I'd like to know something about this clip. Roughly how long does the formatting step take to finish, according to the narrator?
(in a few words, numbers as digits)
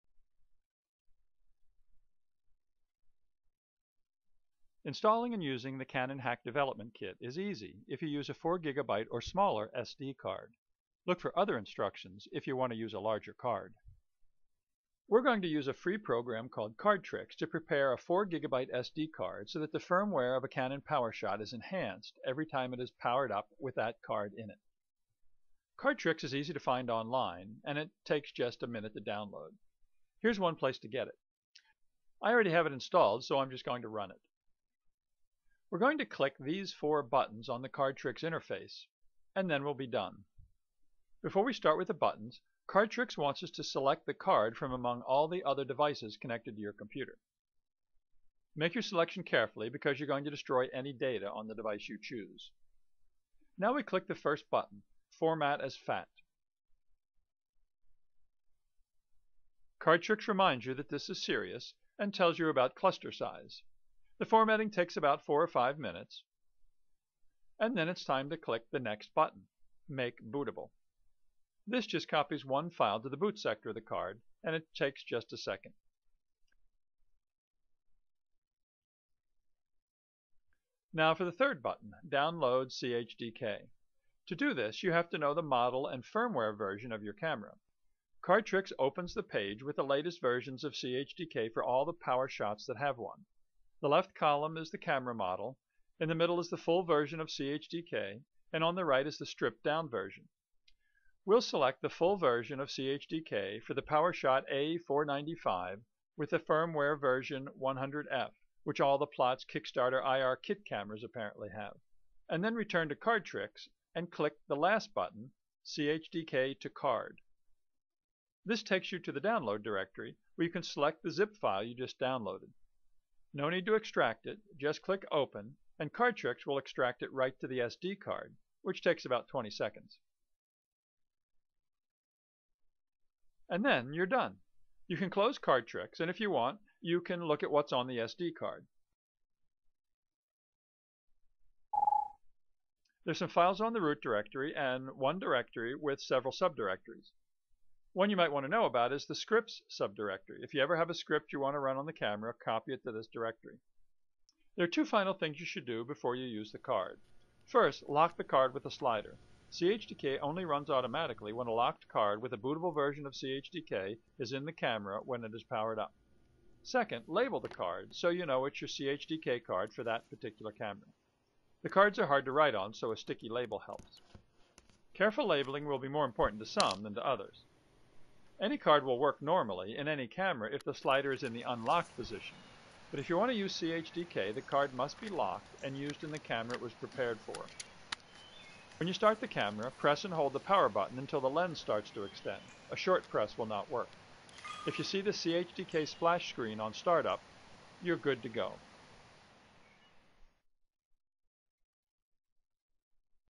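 4 or 5 minutes.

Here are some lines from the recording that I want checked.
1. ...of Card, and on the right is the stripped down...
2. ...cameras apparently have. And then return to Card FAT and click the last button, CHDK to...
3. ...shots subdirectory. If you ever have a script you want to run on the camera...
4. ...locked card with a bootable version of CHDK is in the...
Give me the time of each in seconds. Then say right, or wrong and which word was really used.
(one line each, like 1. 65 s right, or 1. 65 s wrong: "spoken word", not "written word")
1. 97 s wrong: "CHDK", not "Card"
2. 110 s wrong: "Tricks", not "FAT"
3. 149 s wrong: "scripts", not "shots"
4. 161 s right.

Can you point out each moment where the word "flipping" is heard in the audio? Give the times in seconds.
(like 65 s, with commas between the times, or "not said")
not said.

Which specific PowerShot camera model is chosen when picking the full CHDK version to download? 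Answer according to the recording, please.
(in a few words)
A495.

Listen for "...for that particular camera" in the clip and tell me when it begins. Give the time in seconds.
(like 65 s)
169 s.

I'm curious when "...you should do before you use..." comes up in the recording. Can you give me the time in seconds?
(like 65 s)
155 s.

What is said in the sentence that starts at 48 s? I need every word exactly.
Make your selection carefully because you're going to destroy any data on the device you choose.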